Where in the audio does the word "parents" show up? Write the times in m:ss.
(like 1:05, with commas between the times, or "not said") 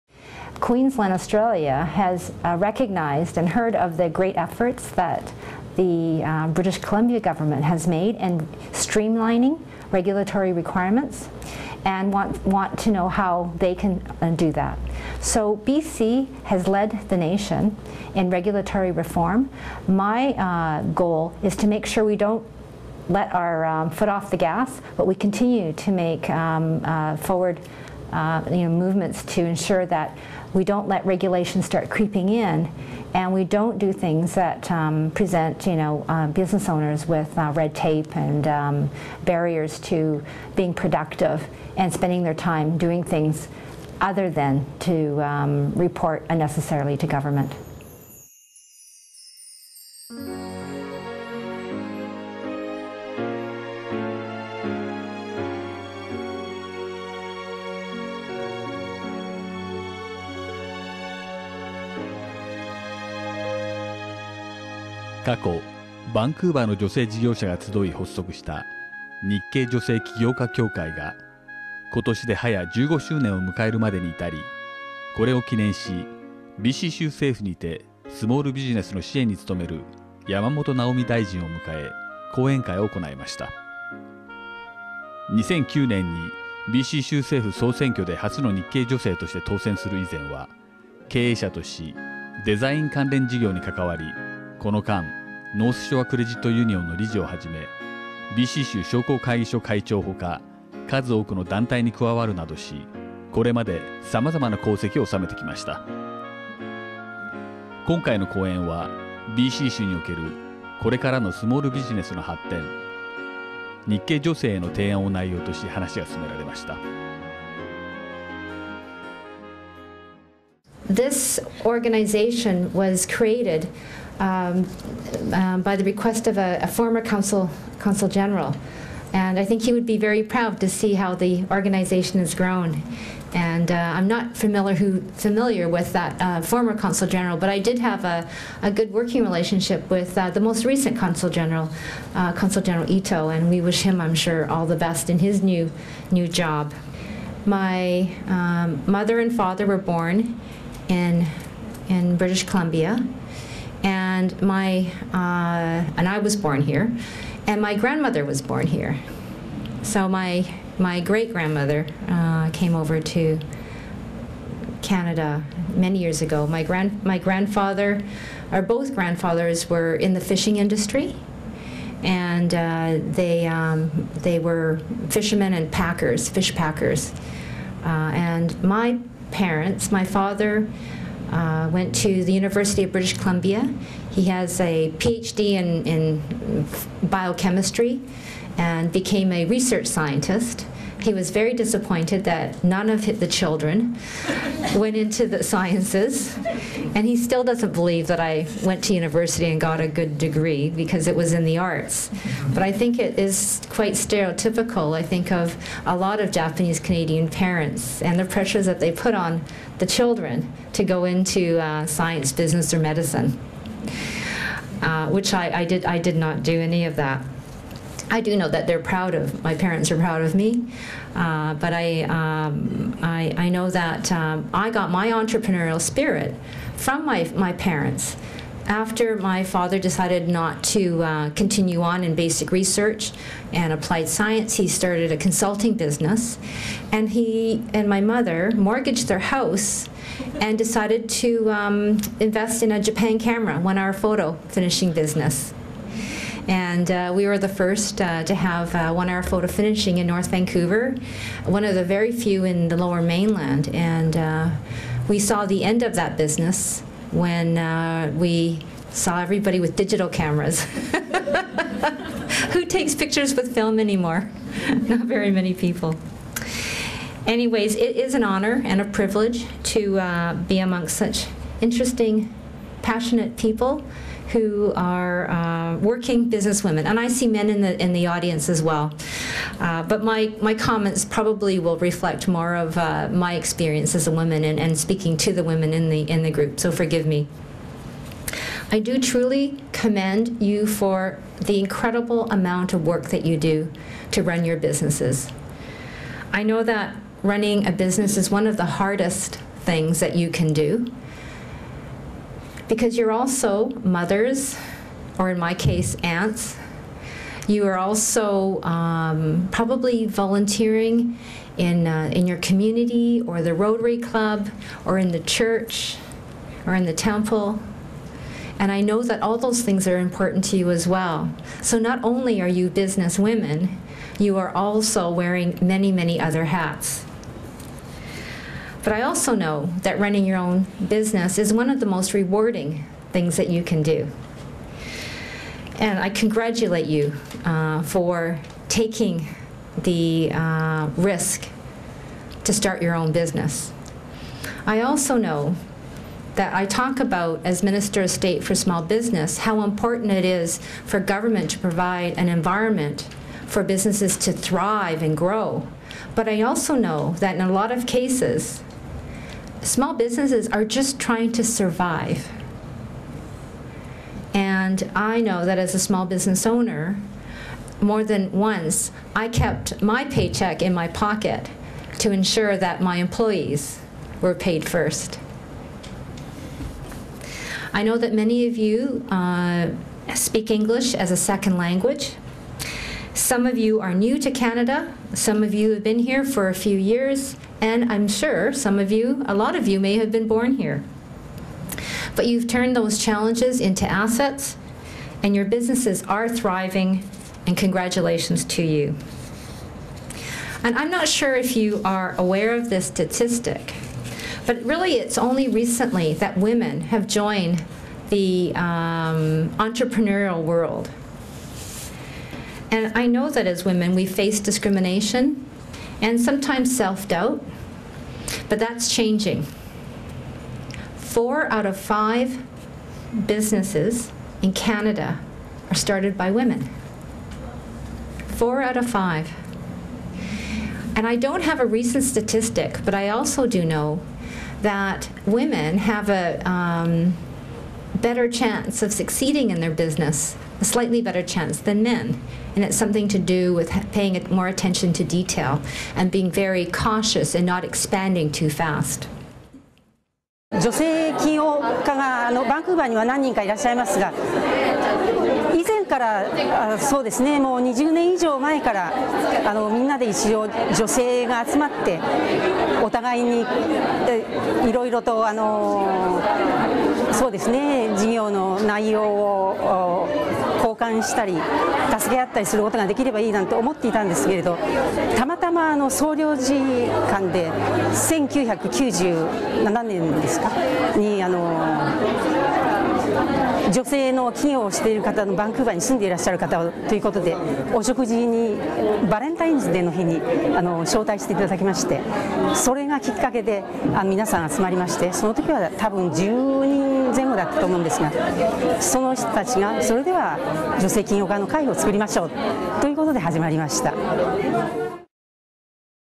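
2:59, 3:27, 3:39, 3:47.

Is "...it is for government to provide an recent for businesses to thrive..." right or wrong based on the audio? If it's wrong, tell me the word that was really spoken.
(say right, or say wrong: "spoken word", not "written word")
wrong: "environment", not "recent".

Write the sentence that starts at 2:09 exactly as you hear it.
And I think he would be very proud to see how the organization has grown.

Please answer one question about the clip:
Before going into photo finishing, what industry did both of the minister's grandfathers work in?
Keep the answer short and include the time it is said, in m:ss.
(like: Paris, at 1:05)
Fishing industry, at 2:50.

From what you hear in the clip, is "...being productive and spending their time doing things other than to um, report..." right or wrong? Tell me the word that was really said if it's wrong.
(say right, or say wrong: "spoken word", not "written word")
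right.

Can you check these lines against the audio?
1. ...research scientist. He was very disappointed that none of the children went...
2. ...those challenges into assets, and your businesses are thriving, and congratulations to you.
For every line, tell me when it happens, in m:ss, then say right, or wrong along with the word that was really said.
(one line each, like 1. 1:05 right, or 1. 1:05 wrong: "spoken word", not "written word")
1. 3:09 right
2. 6:32 right.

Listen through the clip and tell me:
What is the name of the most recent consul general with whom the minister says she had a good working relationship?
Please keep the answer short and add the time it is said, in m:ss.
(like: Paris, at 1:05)
Ito, at 2:22.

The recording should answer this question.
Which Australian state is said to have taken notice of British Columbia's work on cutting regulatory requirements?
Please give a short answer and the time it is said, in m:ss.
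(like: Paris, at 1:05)
Queensland, at 0:00.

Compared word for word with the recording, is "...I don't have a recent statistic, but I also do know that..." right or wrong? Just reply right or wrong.
right.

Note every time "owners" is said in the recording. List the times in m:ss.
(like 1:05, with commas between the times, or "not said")
0:36, 6:06.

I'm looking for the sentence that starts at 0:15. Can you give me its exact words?
So BC has led the nation in regulatory reform.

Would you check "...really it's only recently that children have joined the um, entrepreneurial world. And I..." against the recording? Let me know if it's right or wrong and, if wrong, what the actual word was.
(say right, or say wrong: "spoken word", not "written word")
wrong: "women", not "children".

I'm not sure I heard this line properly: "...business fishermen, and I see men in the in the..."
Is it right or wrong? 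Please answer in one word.
wrong.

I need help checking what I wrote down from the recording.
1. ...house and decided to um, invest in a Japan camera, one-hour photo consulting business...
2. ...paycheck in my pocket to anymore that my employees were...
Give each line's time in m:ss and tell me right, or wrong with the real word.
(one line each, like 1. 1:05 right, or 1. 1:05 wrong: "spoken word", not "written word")
1. 3:59 wrong: "finishing", not "consulting"
2. 6:10 wrong: "ensure", not "anymore".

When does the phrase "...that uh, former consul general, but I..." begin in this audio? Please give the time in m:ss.
2:15.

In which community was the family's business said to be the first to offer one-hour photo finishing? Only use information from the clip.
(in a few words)
North Vancouver.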